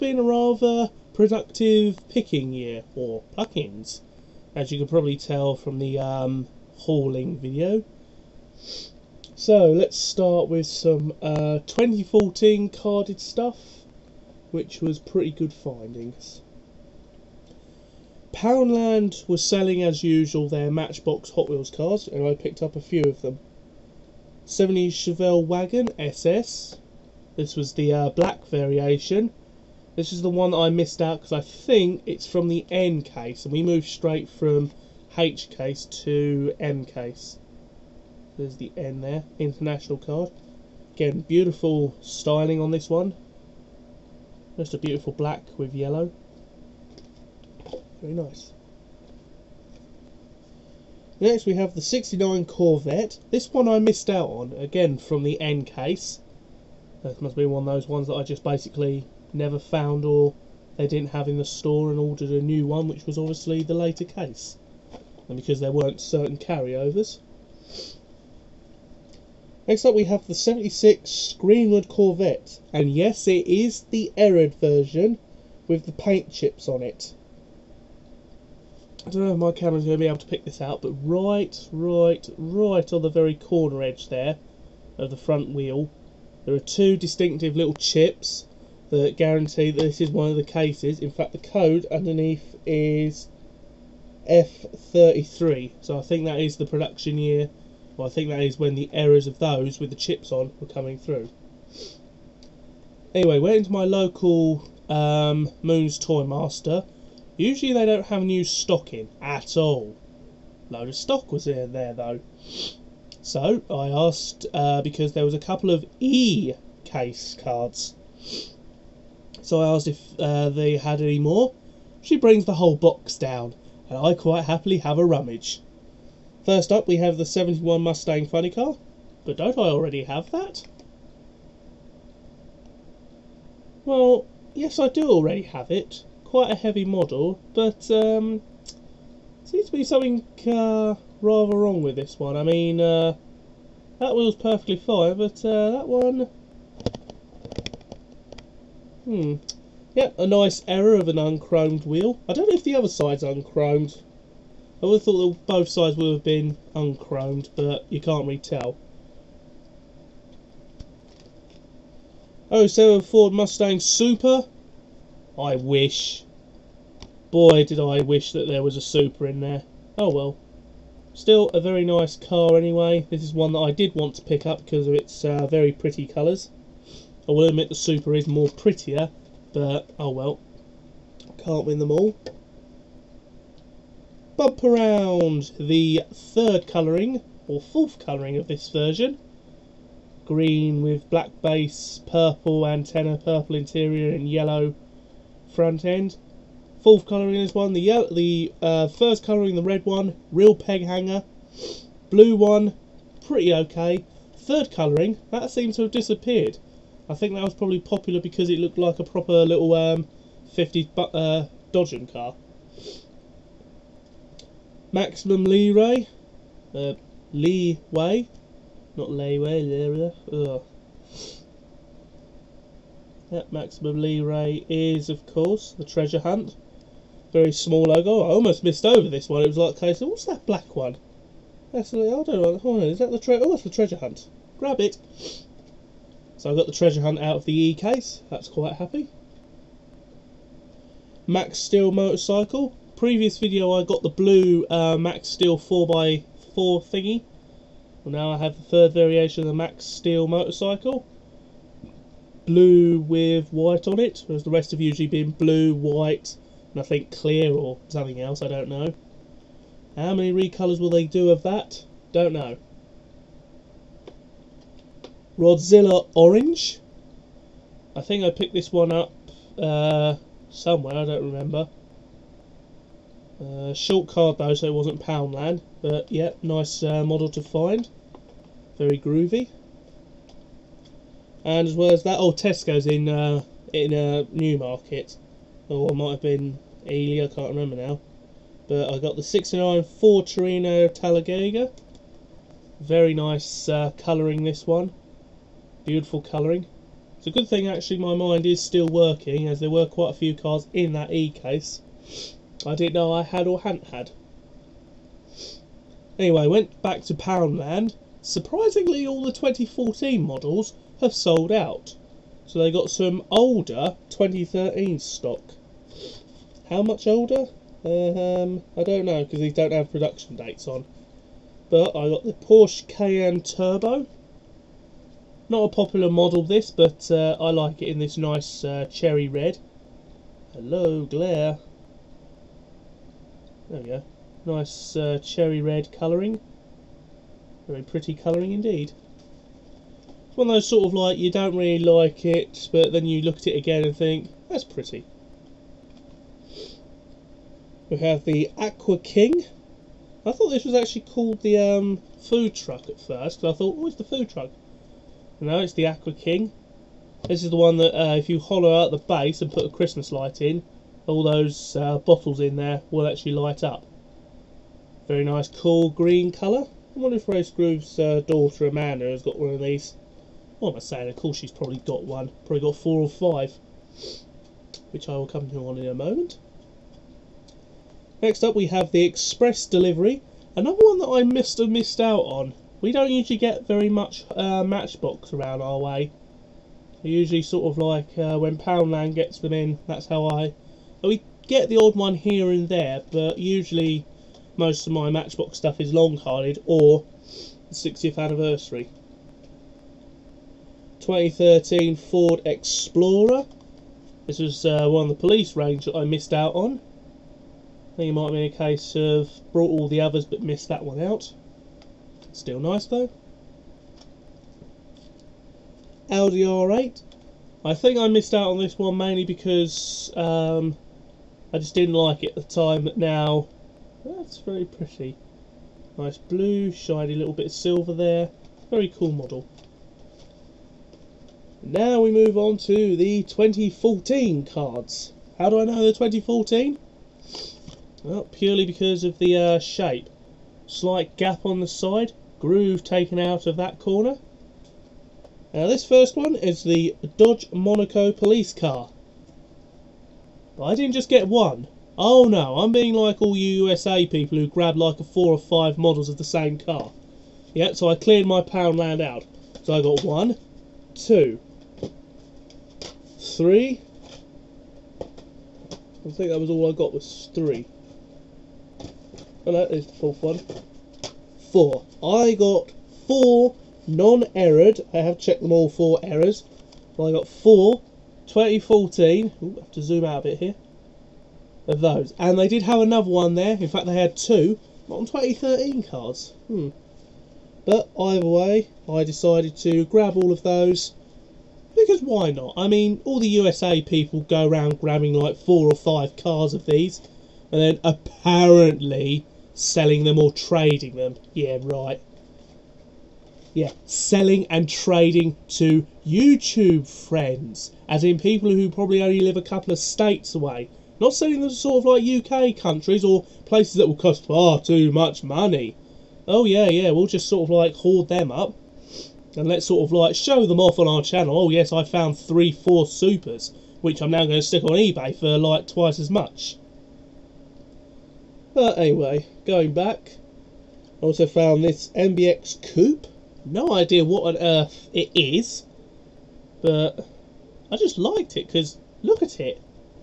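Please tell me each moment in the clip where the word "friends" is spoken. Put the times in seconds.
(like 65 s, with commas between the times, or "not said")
506 s.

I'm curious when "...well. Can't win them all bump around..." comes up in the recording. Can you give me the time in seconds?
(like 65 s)
180 s.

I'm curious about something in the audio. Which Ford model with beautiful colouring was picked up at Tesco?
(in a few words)
69 Ford Torino Talladega.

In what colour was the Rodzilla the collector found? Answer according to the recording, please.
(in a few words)
Orange.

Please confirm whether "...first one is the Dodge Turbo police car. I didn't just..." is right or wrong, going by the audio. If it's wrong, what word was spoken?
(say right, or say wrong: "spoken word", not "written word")
wrong: "Monaco", not "Turbo".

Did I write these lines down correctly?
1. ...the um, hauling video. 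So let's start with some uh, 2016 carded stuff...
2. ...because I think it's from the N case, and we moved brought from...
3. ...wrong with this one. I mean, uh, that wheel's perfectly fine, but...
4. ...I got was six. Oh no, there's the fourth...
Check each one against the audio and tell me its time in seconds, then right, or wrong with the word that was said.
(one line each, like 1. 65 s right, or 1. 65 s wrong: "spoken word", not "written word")
1. 5 s wrong: "2014", not "2016"
2. 31 s wrong: "straight", not "brought"
3. 141 s right
4. 466 s wrong: "three", not "six".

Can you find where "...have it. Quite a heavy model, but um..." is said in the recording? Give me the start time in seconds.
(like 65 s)
135 s.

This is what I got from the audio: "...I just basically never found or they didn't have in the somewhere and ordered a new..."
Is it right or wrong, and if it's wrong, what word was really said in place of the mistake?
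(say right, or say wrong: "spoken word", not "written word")
wrong: "store", not "somewhere".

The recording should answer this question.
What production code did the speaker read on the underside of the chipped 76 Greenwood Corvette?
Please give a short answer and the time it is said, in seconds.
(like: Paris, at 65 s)
F33, at 94 s.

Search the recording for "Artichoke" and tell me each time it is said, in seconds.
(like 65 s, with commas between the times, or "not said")
not said.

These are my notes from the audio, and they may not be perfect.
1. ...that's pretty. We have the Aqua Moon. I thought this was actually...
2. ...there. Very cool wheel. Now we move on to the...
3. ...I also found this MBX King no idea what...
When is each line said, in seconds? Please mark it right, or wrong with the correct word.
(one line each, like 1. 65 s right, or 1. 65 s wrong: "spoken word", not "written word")
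1. 344 s wrong: "King", not "Moon"
2. 427 s wrong: "model", not "wheel"
3. 531 s wrong: "Coupe", not "King".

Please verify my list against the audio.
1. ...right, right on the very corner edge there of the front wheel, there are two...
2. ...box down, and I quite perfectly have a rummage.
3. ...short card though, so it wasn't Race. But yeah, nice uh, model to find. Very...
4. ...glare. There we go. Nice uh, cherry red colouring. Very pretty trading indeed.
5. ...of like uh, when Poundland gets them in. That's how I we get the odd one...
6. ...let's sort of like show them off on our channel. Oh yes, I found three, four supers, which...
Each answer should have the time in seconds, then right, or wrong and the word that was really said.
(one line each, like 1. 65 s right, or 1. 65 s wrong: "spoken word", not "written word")
1. 81 s right
2. 122 s wrong: "happily", not "perfectly"
3. 273 s wrong: "Poundland", not "Race"
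4. 331 s wrong: "colouring", not "trading"
5. 387 s right
6. 519 s right.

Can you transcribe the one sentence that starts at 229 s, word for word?
It was like, okay, so what's that black one?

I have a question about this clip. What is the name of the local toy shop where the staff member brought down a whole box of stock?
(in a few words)
Moon's Toy Master.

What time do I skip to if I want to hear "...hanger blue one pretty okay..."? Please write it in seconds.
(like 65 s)
200 s.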